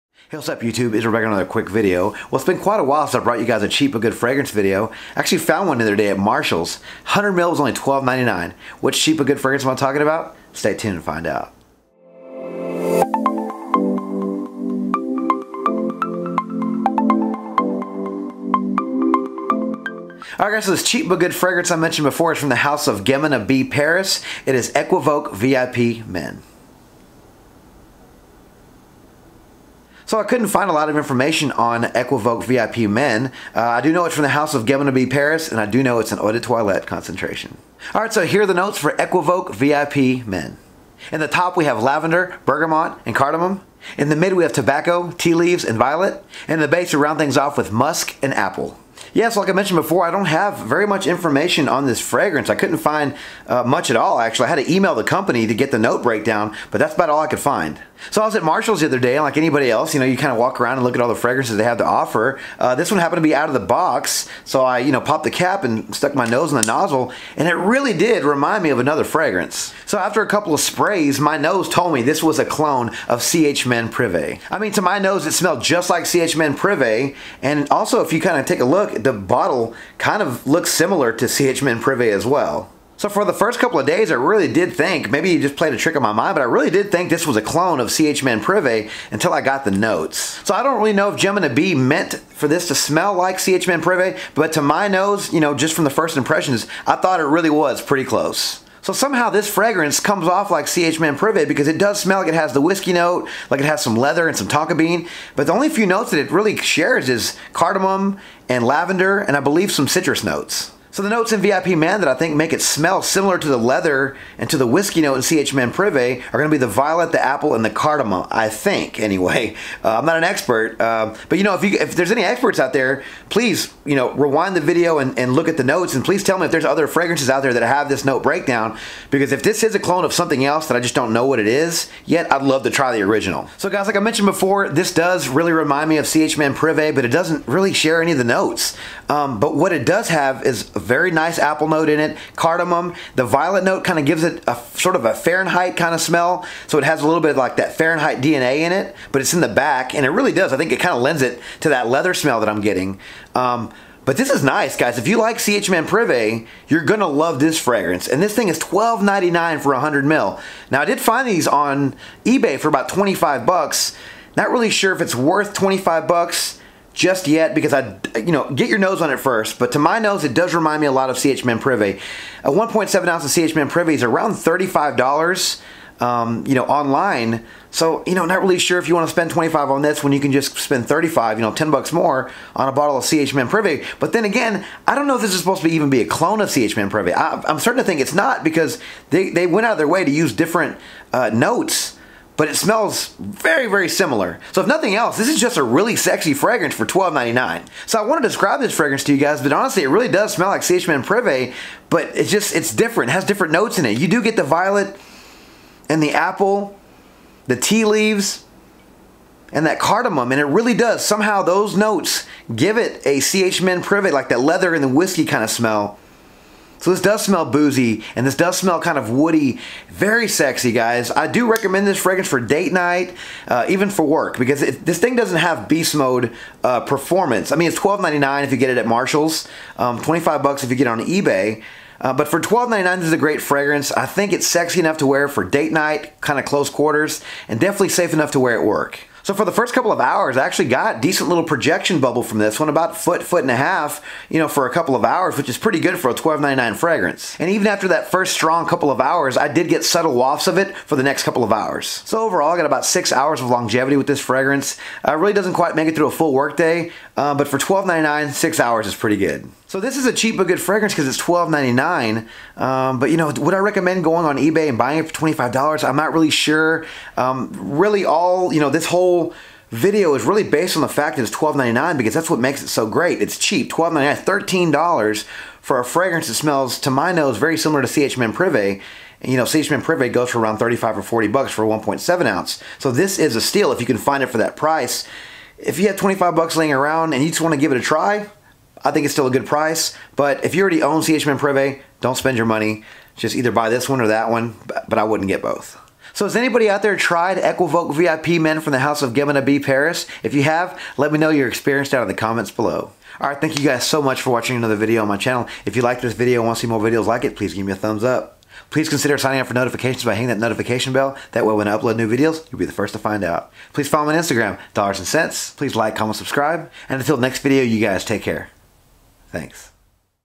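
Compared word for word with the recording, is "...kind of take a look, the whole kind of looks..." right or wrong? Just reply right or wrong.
wrong.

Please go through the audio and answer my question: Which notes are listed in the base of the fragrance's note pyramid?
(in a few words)
musk and apple.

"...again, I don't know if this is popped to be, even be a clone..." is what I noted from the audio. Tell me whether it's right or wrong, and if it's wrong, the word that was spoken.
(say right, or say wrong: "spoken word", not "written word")
wrong: "supposed", not "popped".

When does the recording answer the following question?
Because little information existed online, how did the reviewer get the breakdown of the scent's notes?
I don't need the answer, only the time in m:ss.
0:54.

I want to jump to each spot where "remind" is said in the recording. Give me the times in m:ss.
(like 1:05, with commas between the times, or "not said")
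1:08, 2:15, 2:50.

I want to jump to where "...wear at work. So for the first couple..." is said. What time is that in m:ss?
3:58.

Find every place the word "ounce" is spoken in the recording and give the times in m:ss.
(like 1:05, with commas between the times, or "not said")
2:53, 4:42.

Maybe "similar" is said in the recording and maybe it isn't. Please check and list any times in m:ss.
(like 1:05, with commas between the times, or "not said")
1:20, 1:53, 3:13, 4:37.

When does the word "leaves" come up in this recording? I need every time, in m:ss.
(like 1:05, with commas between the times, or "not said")
0:45, 3:27.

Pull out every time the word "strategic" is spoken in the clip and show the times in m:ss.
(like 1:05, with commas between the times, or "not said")
not said.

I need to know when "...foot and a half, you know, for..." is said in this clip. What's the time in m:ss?
4:03.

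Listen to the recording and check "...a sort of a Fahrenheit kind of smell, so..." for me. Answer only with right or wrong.
right.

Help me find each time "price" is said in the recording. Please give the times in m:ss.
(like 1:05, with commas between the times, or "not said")
4:44, 4:49.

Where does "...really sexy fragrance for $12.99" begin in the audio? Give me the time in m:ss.
3:15.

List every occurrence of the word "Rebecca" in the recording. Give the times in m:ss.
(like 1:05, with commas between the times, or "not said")
0:01.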